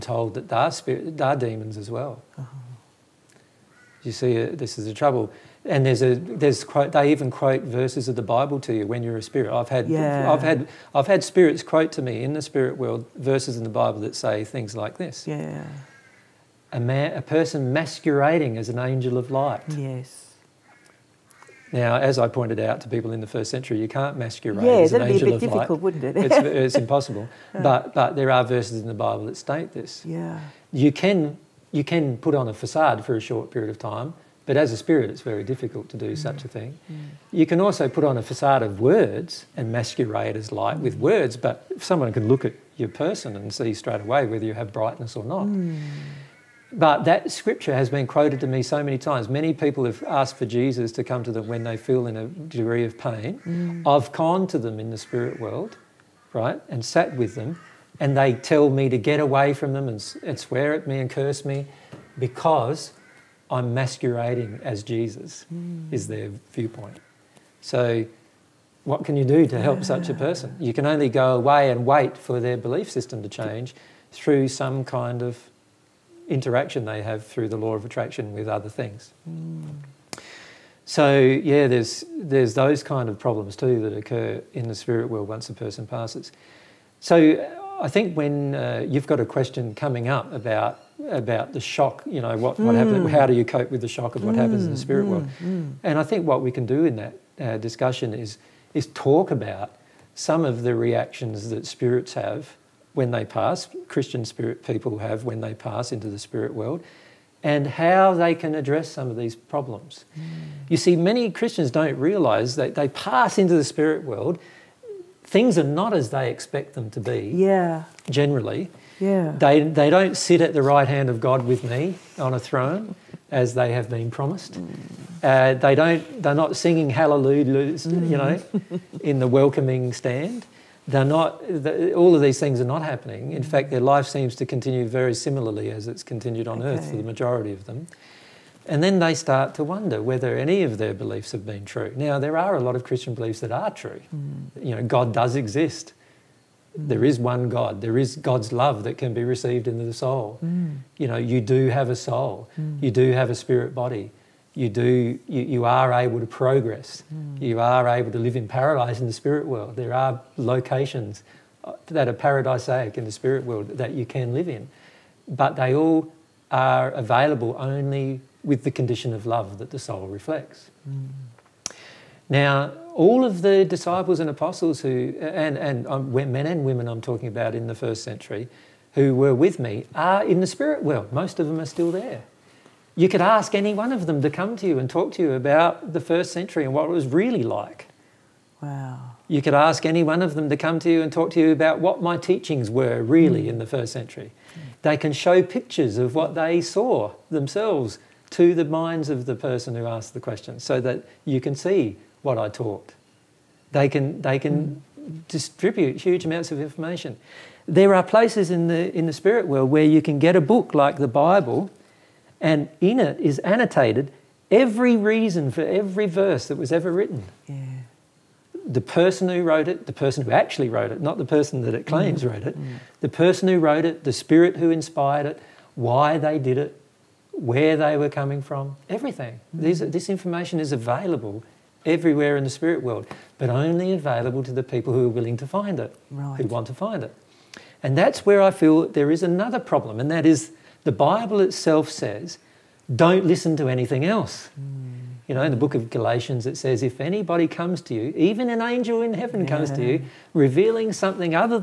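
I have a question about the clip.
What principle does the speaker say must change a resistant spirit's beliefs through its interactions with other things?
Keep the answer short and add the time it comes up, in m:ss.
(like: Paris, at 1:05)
law of attraction, at 1:17.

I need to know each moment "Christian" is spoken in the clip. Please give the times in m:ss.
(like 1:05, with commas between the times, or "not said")
1:43, 1:51, 2:22.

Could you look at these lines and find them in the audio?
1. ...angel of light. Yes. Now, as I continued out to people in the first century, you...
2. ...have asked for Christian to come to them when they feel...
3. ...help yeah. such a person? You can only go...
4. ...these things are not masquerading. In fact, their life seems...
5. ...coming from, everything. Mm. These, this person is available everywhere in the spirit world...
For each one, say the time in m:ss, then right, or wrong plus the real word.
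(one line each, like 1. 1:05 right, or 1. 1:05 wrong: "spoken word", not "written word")
1. 0:18 wrong: "pointed", not "continued"
2. 0:49 wrong: "Jesus", not "Christian"
3. 1:09 right
4. 2:12 wrong: "happening", not "masquerading"
5. 3:48 wrong: "information", not "person".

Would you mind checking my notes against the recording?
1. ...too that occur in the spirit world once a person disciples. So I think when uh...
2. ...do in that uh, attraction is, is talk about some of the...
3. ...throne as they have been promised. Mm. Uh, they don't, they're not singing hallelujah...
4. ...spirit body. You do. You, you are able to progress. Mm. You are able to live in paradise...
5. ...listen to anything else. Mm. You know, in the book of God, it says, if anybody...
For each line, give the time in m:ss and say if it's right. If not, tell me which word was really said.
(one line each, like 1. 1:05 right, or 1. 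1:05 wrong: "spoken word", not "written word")
1. 1:23 wrong: "passes", not "disciples"
2. 1:36 wrong: "discussion", not "attraction"
3. 2:02 right
4. 2:33 right
5. 4:03 wrong: "Galatians", not "God".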